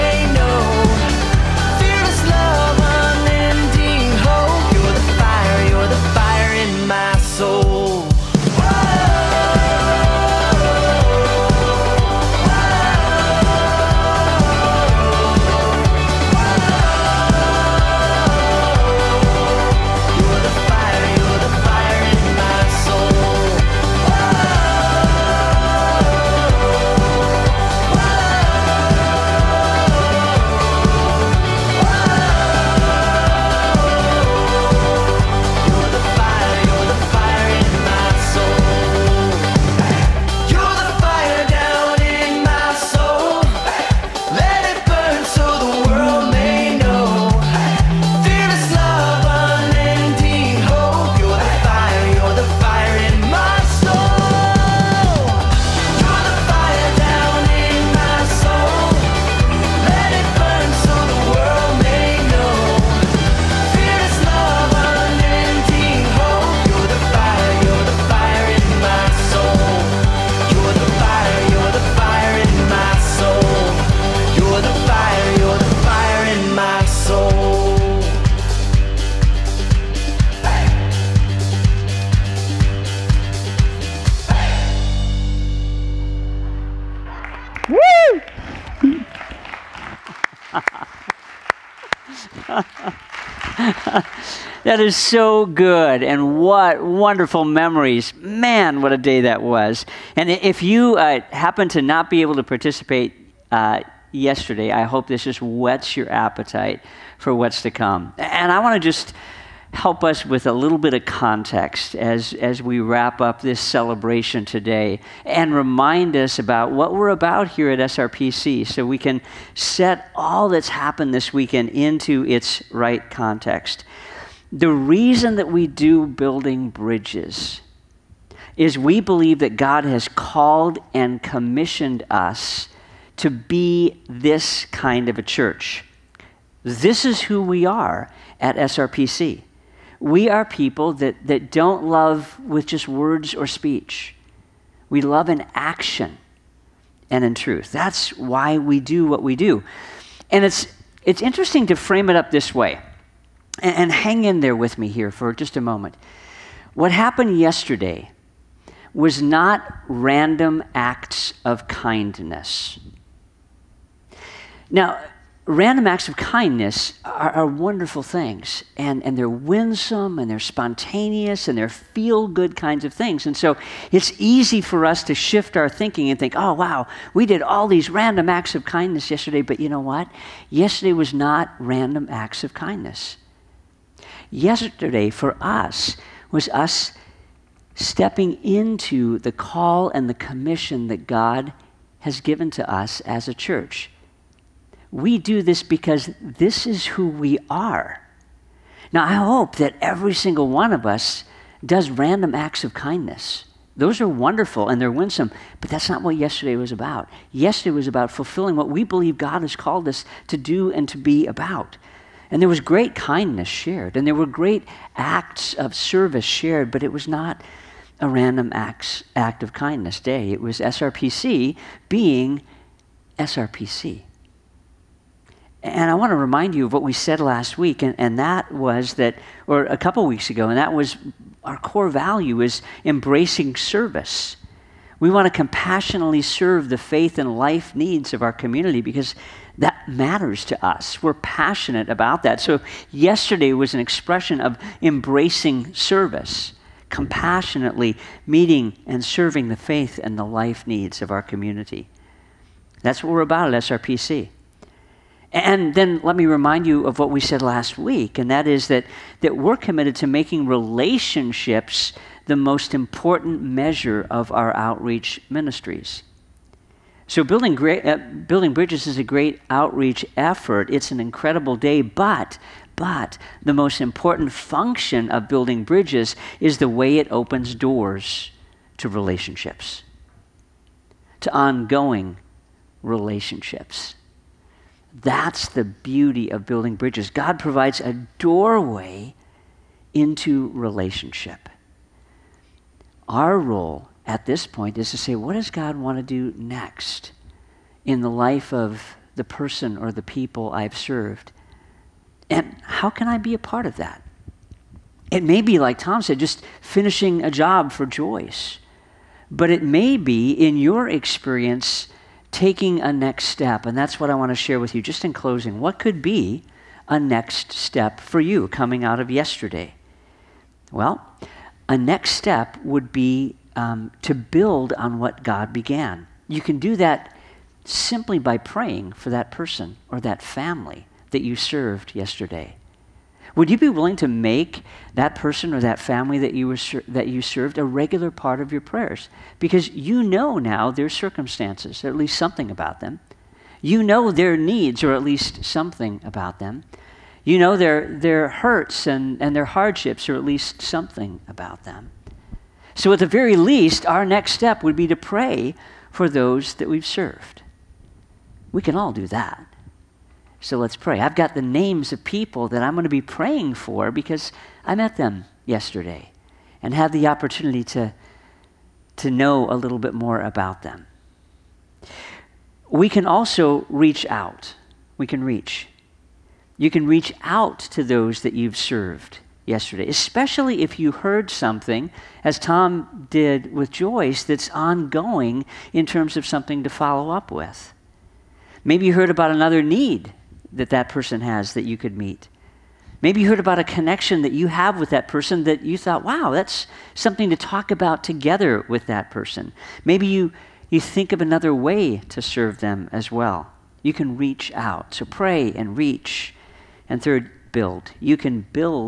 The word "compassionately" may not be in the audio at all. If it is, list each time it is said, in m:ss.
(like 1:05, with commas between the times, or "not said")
3:55, 4:06.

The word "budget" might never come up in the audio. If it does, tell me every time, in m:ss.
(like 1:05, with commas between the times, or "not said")
not said.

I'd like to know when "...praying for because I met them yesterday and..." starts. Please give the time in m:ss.
6:03.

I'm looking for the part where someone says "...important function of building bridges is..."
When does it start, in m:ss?
4:33.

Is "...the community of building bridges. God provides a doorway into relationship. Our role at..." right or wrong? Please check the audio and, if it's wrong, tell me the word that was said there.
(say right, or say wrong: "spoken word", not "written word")
wrong: "beauty", not "community".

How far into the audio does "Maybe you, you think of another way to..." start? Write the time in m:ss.
6:39.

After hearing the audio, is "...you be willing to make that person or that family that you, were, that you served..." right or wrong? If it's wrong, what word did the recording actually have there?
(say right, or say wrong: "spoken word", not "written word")
right.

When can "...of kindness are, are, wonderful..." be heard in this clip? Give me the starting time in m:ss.
2:46.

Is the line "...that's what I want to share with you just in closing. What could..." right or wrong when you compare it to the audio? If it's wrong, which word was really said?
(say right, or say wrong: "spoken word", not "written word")
right.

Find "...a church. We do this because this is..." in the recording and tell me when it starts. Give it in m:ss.
3:13.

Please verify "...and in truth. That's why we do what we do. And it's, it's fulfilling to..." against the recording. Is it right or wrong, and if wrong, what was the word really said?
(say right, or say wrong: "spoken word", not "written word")
wrong: "interesting", not "fulfilling".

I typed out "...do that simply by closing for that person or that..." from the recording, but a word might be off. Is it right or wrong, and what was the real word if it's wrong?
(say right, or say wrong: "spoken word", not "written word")
wrong: "praying", not "closing".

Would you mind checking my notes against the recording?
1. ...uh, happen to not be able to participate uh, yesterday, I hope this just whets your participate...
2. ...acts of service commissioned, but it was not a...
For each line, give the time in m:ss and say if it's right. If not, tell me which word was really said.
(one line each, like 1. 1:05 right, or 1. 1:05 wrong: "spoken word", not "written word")
1. 1:40 wrong: "appetite", not "participate"
2. 3:34 wrong: "shared", not "commissioned".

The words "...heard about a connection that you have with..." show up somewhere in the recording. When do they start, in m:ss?
6:33.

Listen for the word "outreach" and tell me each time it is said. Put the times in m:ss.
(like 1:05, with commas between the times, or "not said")
4:24, 4:29.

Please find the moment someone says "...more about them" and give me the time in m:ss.
6:09.